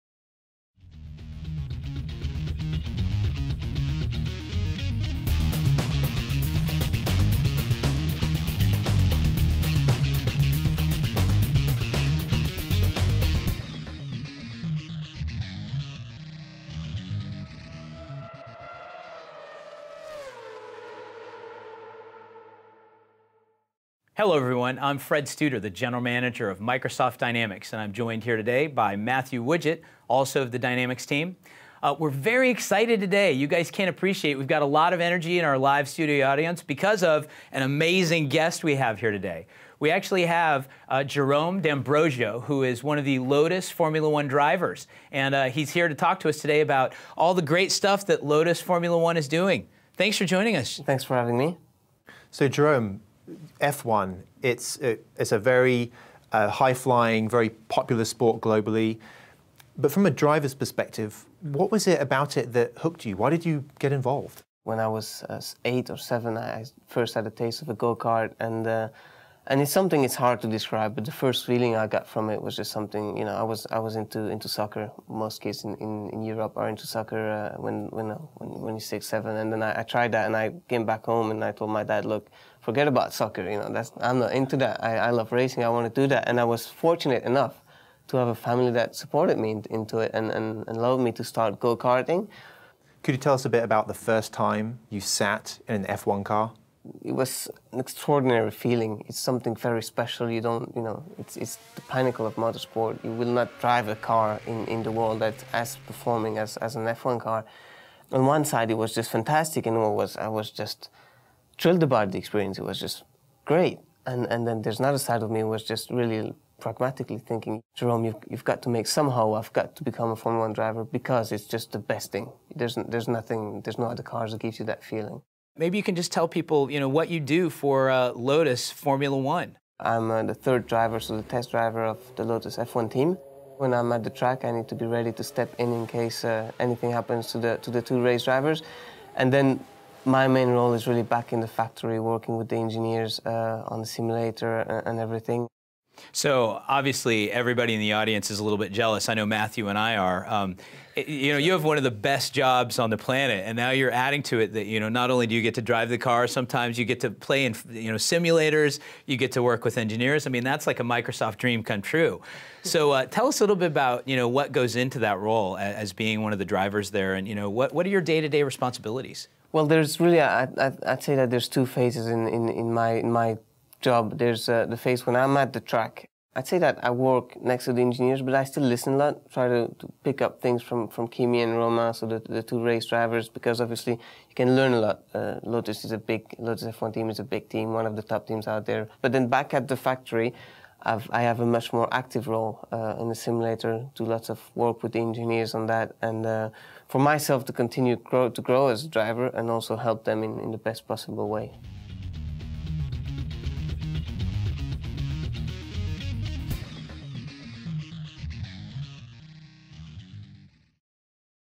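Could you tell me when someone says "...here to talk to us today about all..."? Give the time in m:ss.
0:45.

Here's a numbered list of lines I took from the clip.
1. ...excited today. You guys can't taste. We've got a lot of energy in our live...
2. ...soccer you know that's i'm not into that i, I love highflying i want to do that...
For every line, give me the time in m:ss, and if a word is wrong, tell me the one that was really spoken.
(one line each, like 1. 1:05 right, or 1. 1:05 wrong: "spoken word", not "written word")
1. 0:32 wrong: "appreciate", not "taste"
2. 1:23 wrong: "racing", not "highflying".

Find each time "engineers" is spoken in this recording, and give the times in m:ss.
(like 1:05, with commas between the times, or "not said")
2:22, 2:39, 2:57, 3:14.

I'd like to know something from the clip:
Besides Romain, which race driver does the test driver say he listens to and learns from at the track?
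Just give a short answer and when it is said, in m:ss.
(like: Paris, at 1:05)
Kimi, at 3:01.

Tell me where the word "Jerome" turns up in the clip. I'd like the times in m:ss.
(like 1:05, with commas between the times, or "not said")
0:41, 0:52, 1:57.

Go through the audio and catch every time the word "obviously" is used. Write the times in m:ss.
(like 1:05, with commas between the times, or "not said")
2:26, 3:03.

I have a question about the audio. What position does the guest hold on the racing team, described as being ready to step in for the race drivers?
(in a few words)
Third driver.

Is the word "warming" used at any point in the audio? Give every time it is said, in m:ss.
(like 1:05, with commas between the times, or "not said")
not said.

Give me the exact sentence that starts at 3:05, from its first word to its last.
Uh, Lotus is a big, Lotus F1 team is a big team, one of the top teams out there.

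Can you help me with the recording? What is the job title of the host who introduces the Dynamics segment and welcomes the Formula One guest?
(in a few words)
General Manager.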